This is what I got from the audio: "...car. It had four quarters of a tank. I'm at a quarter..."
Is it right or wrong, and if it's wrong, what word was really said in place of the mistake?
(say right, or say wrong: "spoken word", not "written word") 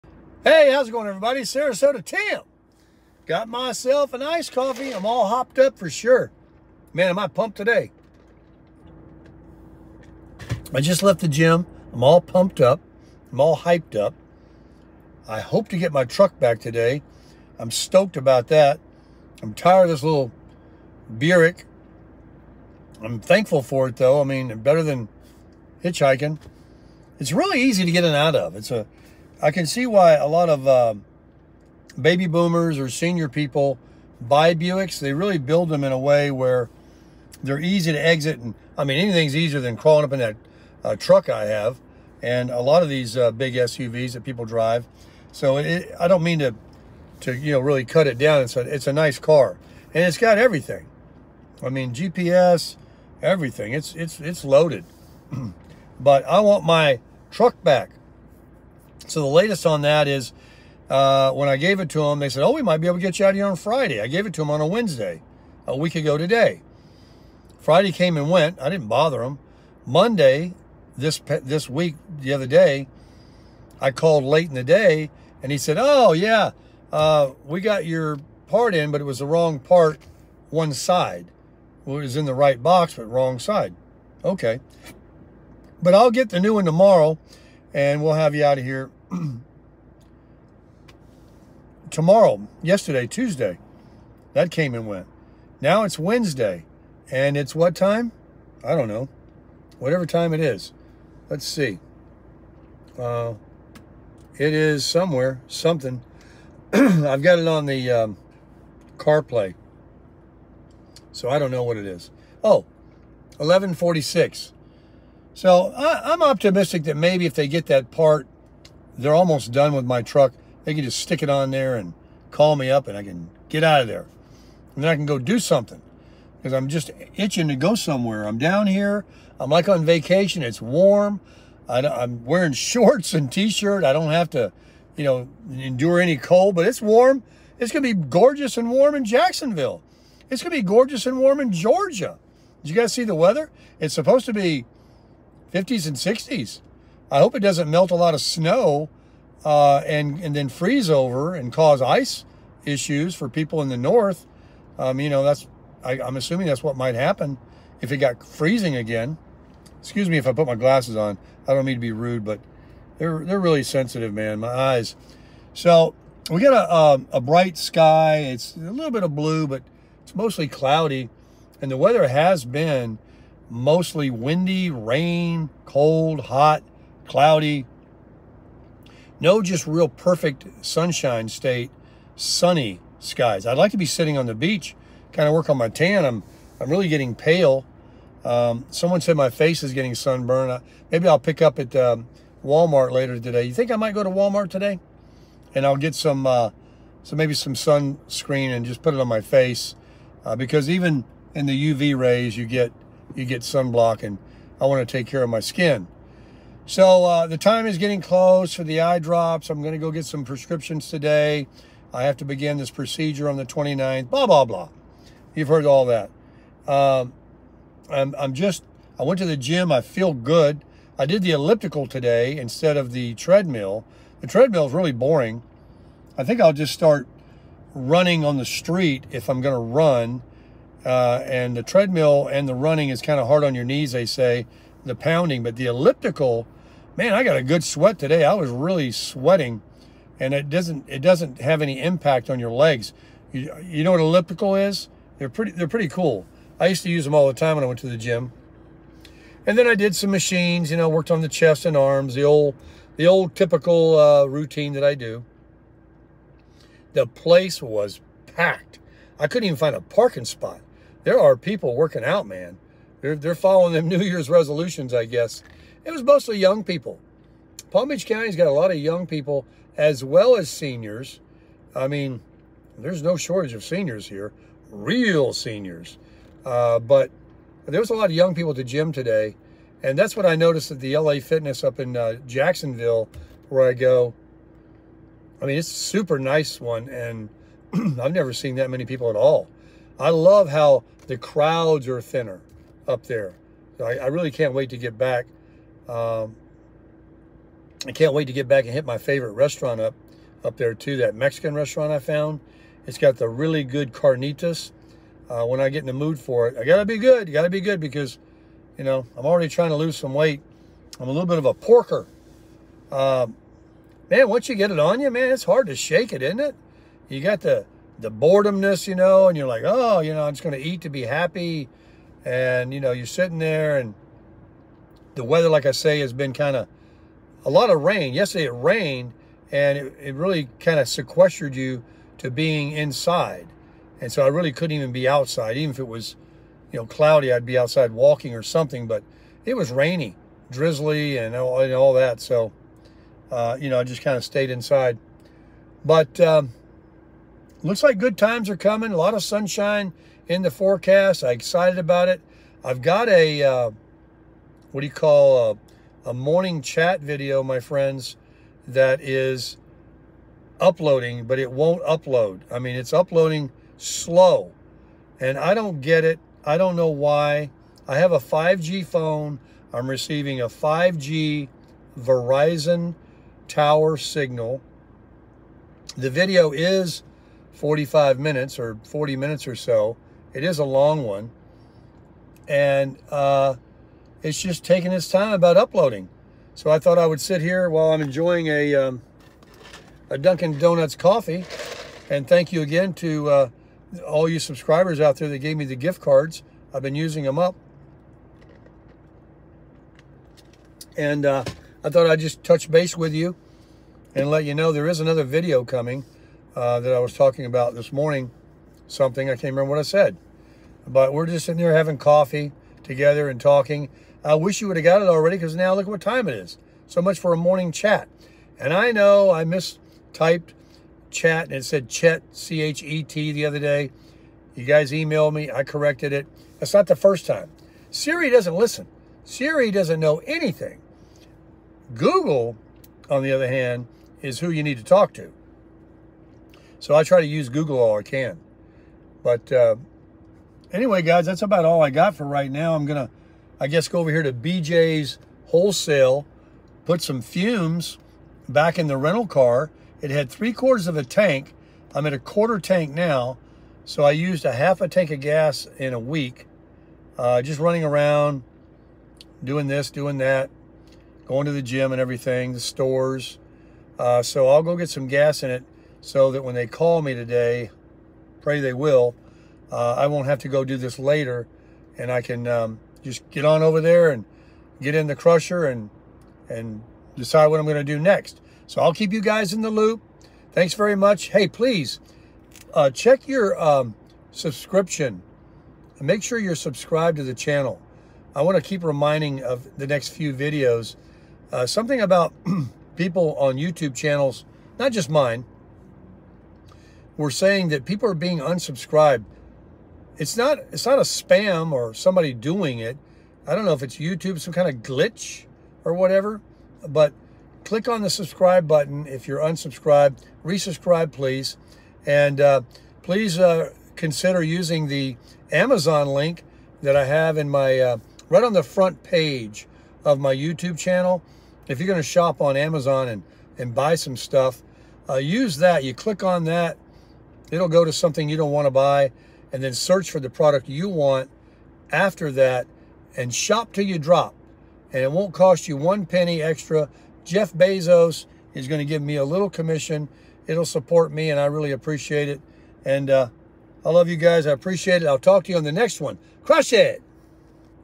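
wrong: "three", not "four".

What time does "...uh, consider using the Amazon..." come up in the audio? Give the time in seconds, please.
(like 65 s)
513 s.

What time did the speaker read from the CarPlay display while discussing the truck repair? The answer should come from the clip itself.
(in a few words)
11:46.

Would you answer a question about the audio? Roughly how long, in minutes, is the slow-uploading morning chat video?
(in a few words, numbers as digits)
45 minutes.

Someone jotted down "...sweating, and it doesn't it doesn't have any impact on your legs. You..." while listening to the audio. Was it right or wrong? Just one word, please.
right.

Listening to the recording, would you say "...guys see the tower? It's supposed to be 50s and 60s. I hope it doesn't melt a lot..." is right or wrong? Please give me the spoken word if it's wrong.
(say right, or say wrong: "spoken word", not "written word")
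wrong: "weather", not "tower".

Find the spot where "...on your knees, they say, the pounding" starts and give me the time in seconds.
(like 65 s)
233 s.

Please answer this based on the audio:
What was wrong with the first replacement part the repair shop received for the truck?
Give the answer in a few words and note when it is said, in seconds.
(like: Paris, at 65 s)
wrong side, at 83 s.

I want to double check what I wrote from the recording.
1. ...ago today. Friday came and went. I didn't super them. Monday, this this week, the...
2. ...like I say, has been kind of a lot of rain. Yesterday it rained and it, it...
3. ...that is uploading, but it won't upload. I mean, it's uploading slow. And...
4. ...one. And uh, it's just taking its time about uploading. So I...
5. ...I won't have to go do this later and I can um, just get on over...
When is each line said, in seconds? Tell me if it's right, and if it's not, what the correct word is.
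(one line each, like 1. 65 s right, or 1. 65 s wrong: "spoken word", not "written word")
1. 65 s wrong: "bother", not "super"
2. 325 s right
3. 358 s right
4. 381 s right
5. 469 s right.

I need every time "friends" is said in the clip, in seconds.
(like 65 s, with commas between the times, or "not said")
357 s.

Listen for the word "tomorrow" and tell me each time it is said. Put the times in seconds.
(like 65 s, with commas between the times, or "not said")
86 s, 91 s.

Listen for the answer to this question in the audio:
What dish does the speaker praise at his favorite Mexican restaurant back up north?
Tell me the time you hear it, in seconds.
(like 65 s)
303 s.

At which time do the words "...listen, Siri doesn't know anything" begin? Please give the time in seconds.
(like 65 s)
428 s.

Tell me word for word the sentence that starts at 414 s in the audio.
I wish you would have got it already because now look what time it is.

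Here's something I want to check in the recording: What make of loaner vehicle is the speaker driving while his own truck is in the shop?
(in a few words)
Buick.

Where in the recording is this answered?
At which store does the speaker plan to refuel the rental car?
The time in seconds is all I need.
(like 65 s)
444 s.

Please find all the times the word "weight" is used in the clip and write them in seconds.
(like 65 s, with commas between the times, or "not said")
310 s.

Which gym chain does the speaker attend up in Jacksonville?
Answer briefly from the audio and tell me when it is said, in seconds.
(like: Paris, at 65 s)
LA Fitness, at 280 s.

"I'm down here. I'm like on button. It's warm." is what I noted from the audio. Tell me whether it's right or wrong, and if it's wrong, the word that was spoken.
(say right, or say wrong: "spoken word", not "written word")
wrong: "vacation", not "button".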